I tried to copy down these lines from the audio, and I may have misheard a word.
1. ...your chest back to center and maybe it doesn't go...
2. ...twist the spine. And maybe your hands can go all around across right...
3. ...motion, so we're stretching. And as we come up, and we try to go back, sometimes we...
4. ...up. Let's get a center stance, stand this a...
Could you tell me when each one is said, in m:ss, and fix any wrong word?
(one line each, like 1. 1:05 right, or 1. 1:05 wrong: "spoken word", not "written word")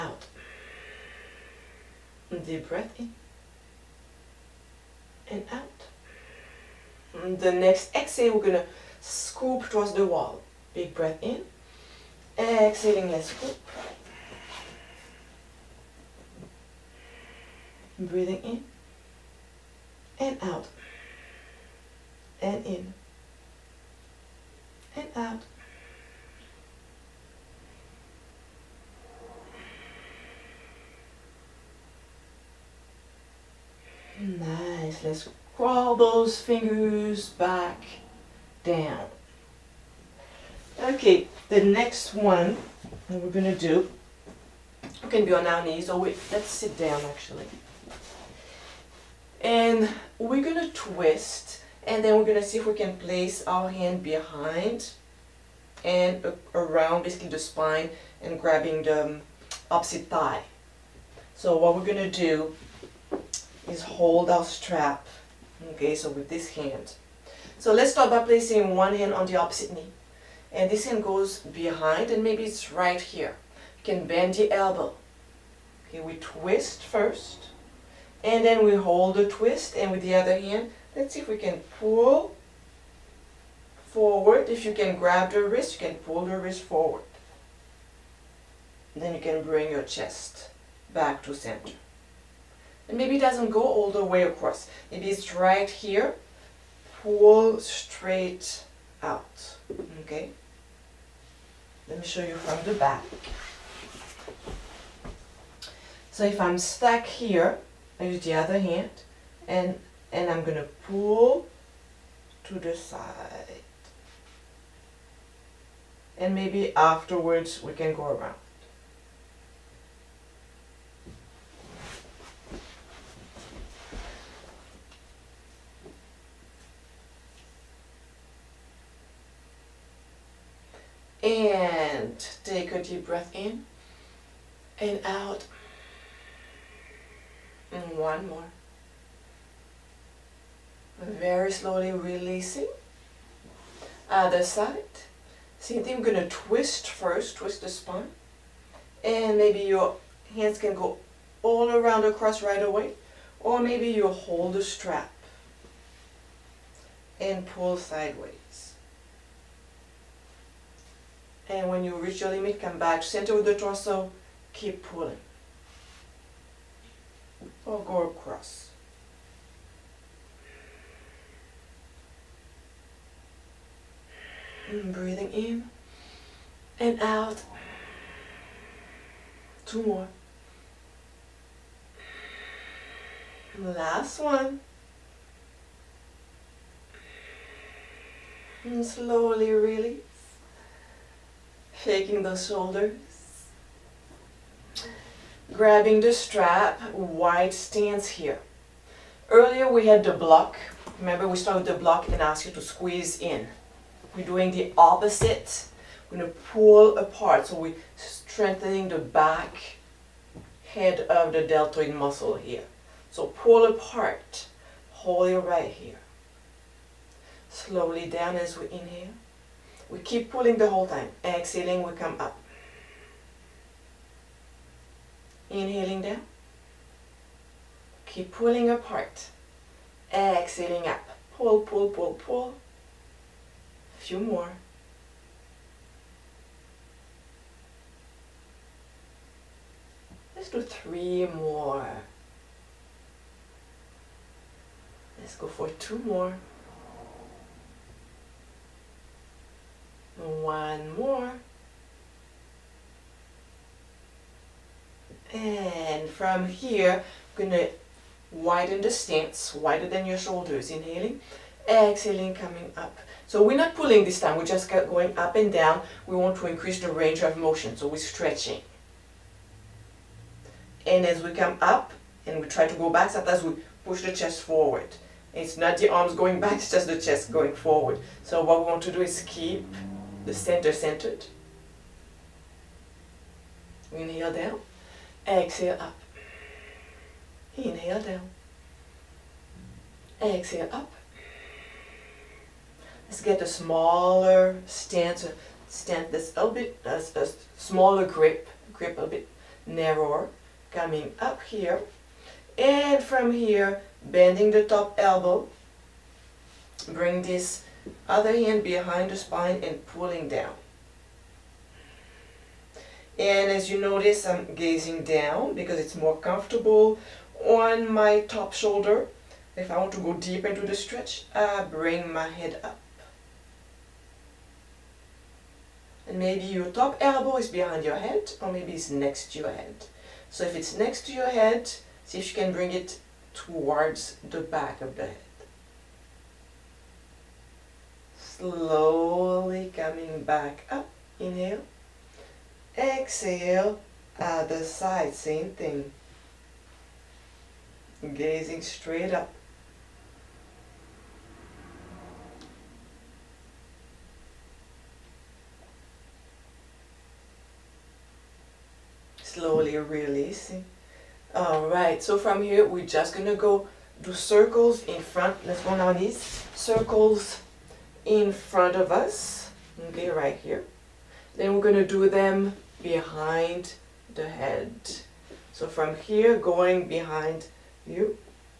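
1. 1:29 right
2. 2:27 right
3. 4:27 right
4. 4:50 wrong: "smaller", not "center".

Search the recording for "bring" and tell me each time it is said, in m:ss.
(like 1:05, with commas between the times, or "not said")
1:29, 5:06, 5:21, 5:32.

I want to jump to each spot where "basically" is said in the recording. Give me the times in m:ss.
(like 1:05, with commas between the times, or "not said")
0:57.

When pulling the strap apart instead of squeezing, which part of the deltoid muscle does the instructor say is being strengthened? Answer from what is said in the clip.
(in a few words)
back head.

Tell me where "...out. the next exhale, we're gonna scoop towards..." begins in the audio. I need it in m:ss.
0:05.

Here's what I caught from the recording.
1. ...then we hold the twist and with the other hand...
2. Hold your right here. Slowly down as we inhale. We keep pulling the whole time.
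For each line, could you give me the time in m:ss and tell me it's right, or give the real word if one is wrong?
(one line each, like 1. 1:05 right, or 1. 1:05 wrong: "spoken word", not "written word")
1. 1:18 right
2. 3:34 right.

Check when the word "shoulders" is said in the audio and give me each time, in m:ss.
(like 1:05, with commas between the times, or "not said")
3:12, 4:20, 5:18.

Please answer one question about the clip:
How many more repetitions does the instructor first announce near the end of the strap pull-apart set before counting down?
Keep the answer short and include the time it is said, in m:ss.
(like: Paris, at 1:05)
3, at 4:00.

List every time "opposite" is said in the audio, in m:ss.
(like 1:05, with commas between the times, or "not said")
0:59, 1:09, 3:24.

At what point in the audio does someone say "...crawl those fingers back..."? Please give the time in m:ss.
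0:35.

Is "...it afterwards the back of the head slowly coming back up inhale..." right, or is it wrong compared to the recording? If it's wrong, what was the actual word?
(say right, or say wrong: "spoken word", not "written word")
wrong: "towards", not "afterwards".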